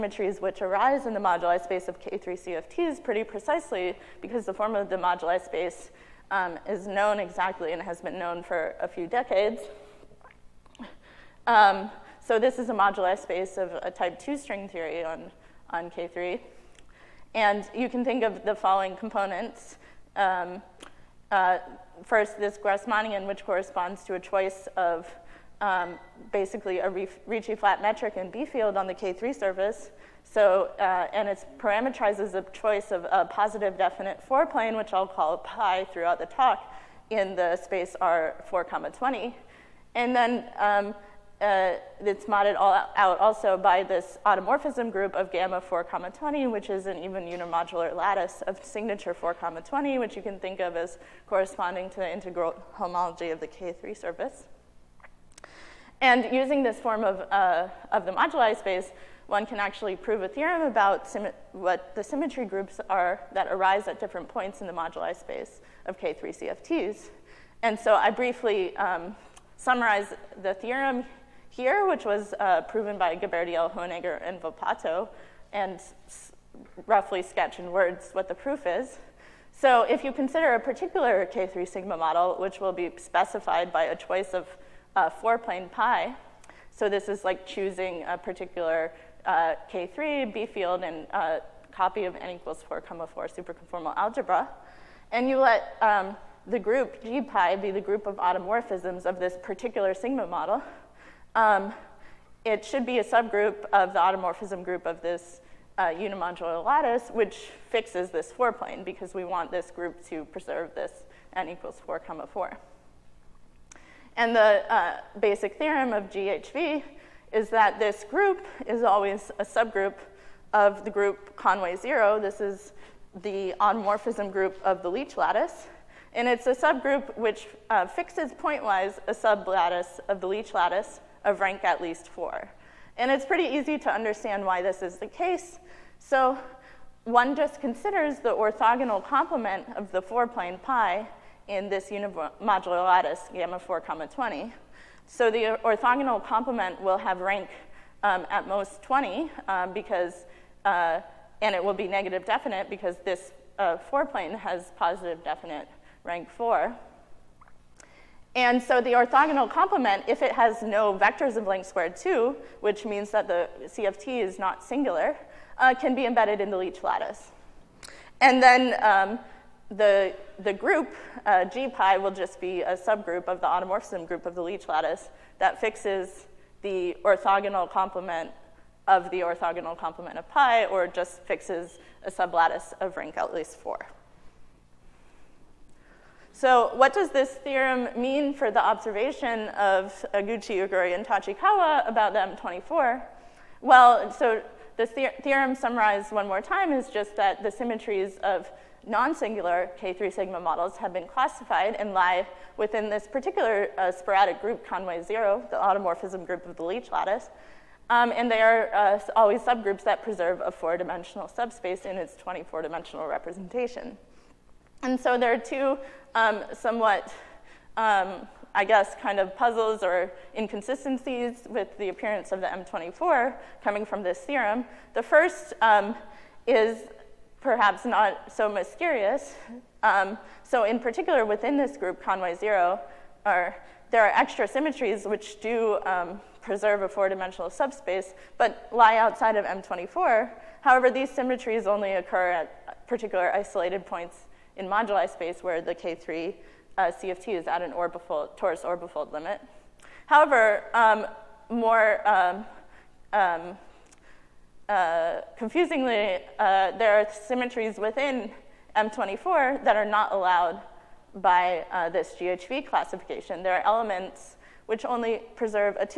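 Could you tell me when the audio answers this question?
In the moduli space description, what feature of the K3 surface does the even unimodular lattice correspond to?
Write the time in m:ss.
0:52.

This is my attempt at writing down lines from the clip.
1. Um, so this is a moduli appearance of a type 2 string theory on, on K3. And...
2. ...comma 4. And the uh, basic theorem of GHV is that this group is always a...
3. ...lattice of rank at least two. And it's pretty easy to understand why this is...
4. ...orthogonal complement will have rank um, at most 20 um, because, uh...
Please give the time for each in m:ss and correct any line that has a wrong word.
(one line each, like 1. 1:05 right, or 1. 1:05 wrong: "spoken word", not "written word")
1. 0:11 wrong: "space", not "appearance"
2. 1:51 right
3. 2:10 wrong: "four", not "two"
4. 2:25 right.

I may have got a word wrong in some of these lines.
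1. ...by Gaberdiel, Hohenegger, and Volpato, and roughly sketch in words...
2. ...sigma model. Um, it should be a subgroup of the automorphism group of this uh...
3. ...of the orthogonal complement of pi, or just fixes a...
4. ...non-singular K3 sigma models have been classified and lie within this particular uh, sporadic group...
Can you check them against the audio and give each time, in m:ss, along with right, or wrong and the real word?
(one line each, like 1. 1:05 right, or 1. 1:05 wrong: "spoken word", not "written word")
1. 1:12 right
2. 1:39 right
3. 2:58 right
4. 3:18 right.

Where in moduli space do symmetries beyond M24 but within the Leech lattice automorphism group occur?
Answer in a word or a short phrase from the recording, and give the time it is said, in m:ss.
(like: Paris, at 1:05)
torus orbifold limit, at 4:08.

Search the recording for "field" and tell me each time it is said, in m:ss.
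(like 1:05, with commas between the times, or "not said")
0:28, 1:30.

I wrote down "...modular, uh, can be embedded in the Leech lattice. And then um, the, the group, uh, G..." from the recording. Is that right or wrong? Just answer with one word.
wrong.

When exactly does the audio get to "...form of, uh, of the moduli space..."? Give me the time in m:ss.
0:56.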